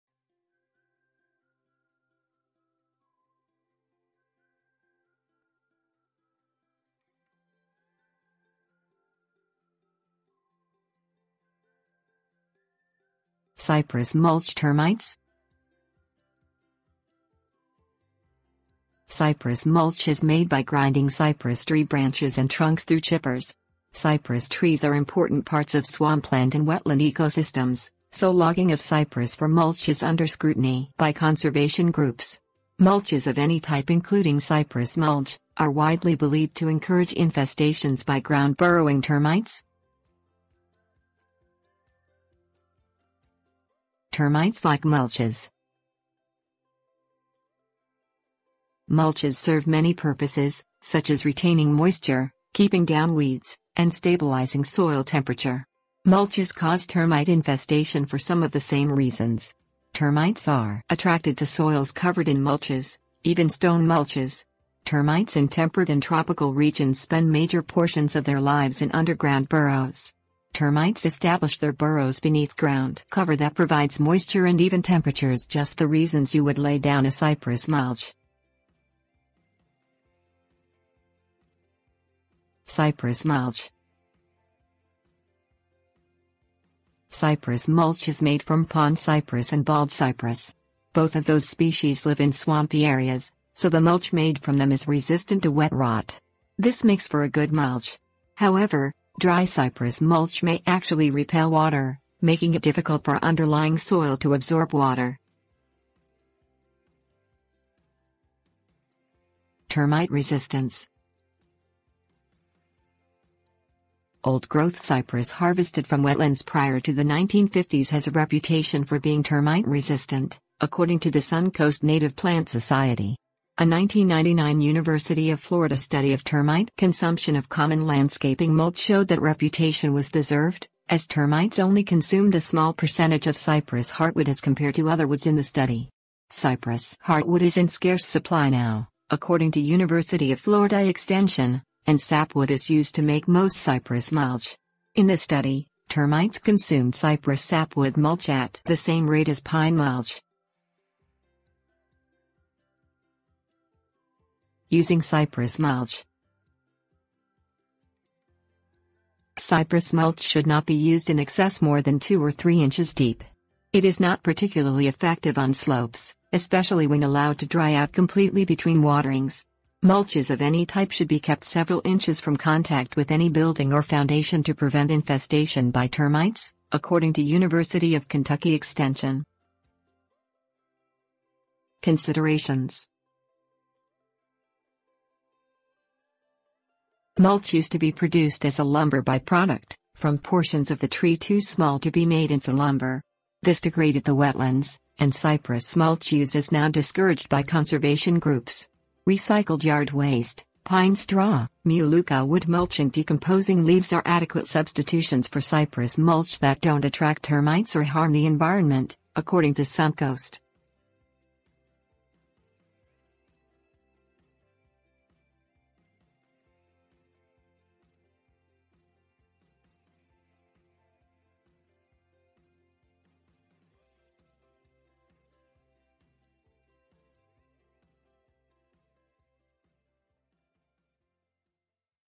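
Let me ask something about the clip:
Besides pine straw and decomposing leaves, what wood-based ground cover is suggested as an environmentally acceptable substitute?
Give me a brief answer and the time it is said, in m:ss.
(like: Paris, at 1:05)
melaleuca wood mulch, at 3:21.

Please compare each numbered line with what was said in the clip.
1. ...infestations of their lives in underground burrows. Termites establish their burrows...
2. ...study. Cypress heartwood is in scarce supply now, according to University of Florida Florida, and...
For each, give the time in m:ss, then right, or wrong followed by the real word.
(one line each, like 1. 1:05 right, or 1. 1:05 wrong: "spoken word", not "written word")
1. 1:07 wrong: "portions", not "infestations"
2. 2:15 wrong: "Extension", not "Florida".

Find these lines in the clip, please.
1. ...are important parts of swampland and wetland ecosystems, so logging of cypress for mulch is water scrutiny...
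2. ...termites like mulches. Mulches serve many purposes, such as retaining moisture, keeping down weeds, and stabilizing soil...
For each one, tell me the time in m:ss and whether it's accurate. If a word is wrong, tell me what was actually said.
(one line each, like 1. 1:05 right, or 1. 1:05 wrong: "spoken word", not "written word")
1. 0:24 wrong: "under", not "water"
2. 0:44 right.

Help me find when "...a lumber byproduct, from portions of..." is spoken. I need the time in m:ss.
3:08.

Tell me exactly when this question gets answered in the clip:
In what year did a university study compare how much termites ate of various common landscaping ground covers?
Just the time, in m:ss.
2:03.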